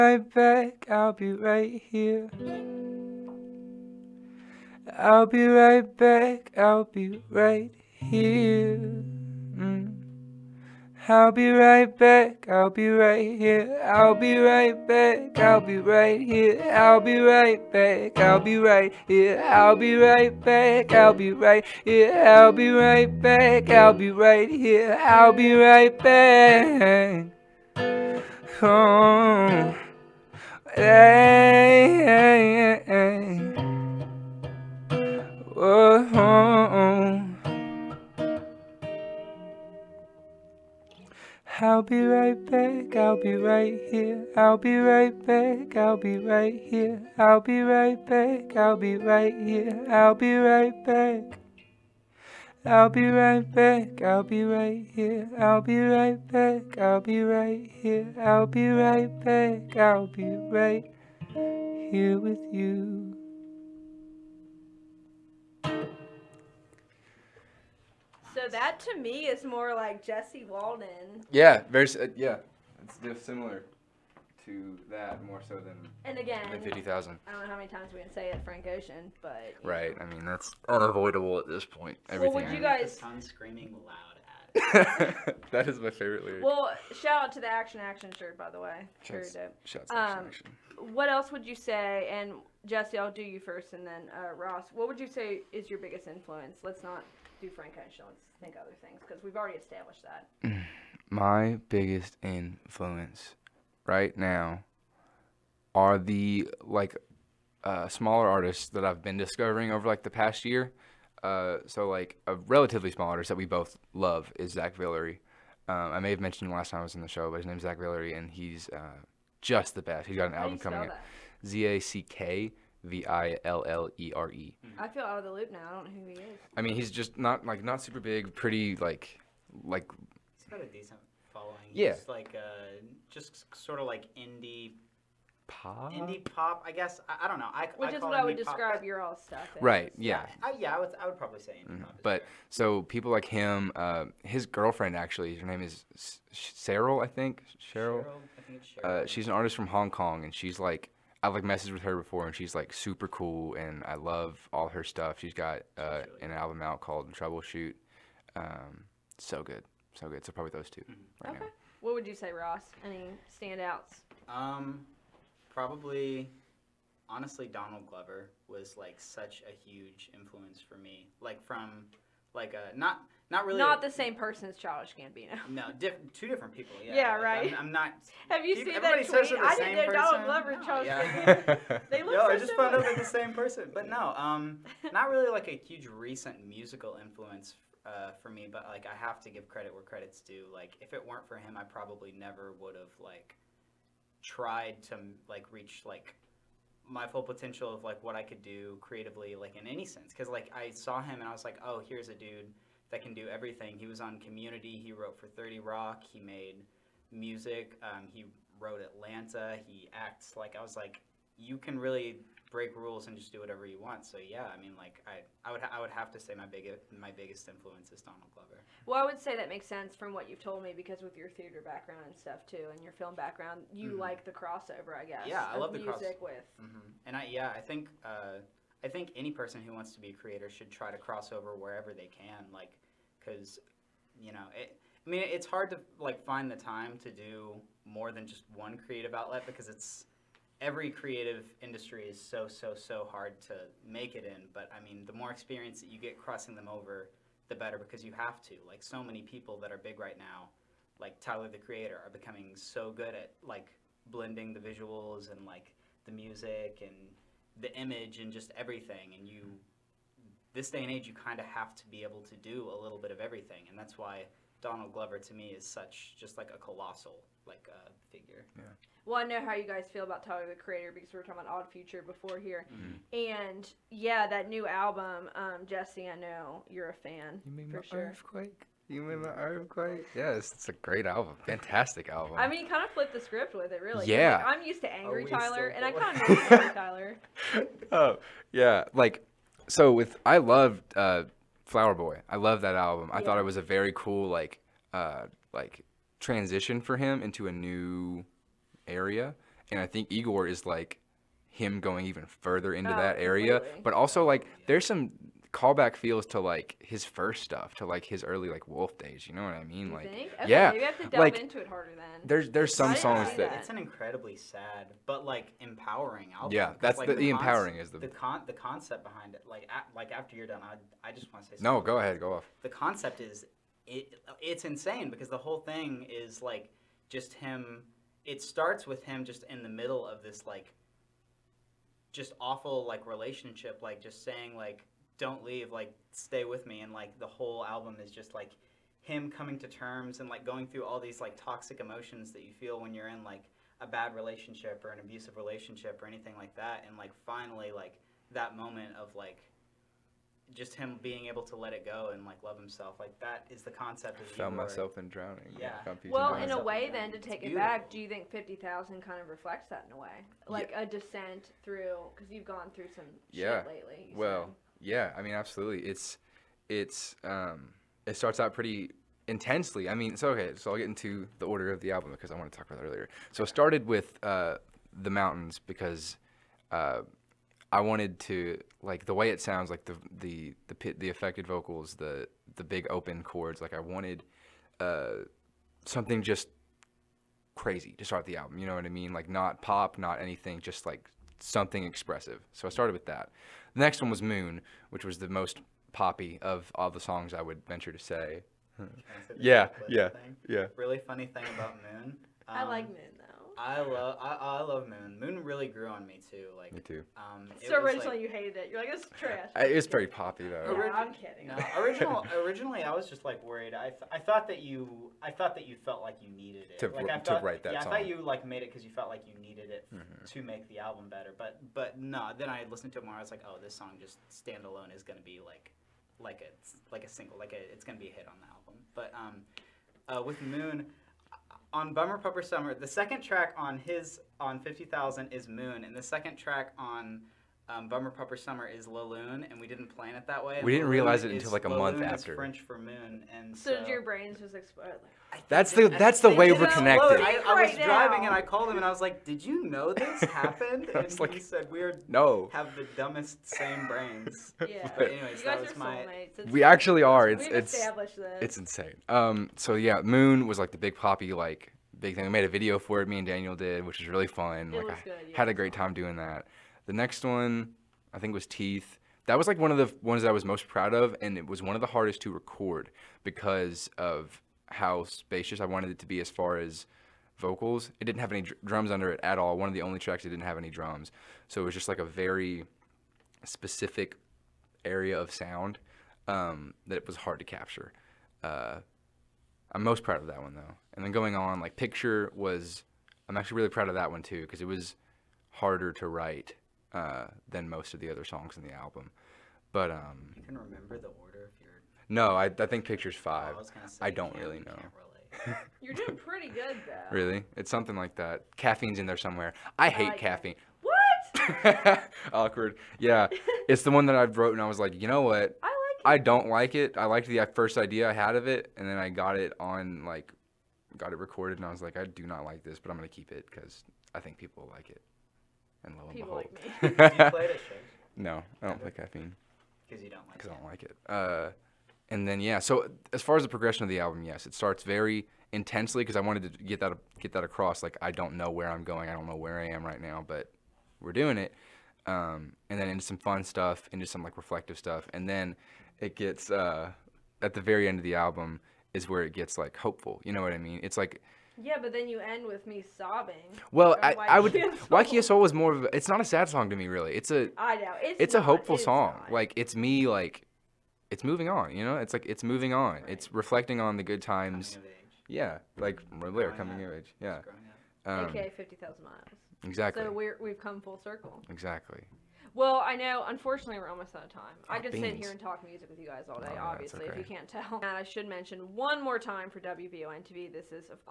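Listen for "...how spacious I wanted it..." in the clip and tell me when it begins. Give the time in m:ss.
7:54.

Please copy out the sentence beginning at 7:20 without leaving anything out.
We didn't realize it until like a month La lune after.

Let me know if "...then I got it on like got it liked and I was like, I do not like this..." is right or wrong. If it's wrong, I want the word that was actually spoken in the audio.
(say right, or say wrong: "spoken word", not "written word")
wrong: "recorded", not "liked".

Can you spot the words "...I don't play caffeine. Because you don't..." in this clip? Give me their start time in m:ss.
8:48.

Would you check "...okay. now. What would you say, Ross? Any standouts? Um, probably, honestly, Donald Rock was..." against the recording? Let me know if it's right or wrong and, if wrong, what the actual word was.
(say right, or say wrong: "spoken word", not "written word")
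wrong: "Glover", not "Rock".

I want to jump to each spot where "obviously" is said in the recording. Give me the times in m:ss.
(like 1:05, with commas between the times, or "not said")
9:36.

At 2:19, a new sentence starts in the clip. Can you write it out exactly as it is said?
right yeah yeah I, yeah I, would, I would probably say mm-hmm.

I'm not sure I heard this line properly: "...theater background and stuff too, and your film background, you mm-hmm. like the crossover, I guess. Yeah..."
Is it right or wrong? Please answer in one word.
right.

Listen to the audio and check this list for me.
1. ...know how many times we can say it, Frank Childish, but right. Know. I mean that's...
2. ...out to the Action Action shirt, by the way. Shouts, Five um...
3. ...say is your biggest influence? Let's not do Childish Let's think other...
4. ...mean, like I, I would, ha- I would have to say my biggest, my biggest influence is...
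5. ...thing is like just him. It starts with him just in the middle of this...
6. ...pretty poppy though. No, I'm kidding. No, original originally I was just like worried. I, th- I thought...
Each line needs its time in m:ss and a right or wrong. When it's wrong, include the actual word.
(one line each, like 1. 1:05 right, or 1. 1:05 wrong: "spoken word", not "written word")
1. 1:17 wrong: "Ocean", not "Childish"
2. 1:27 wrong: "Shouts", not "Five"
3. 1:35 wrong: "Frank", not "Childish"
4. 3:34 right
5. 5:25 right
6. 6:49 right.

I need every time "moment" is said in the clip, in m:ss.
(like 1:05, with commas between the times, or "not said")
5:48.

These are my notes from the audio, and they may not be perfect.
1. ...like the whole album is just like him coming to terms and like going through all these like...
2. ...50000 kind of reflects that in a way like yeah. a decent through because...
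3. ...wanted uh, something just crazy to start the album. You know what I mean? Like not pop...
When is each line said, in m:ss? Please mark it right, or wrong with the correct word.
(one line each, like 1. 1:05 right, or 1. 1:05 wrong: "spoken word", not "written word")
1. 5:36 right
2. 5:58 wrong: "descent", not "decent"
3. 6:23 right.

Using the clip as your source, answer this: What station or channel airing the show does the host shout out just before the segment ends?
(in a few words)
WBON TV.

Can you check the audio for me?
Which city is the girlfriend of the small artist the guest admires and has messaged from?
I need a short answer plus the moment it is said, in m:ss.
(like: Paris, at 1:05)
Hong Kong, at 2:29.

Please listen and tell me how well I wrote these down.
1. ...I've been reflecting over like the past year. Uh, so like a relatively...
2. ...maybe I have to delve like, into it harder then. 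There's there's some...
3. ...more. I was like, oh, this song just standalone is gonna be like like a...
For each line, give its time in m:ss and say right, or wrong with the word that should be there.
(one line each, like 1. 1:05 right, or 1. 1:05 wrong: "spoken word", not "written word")
1. 1:48 wrong: "discovering", not "reflecting"
2. 5:10 right
3. 7:03 right.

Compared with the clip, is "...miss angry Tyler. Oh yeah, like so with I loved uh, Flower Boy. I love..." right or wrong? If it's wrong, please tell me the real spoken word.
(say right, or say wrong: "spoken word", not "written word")
right.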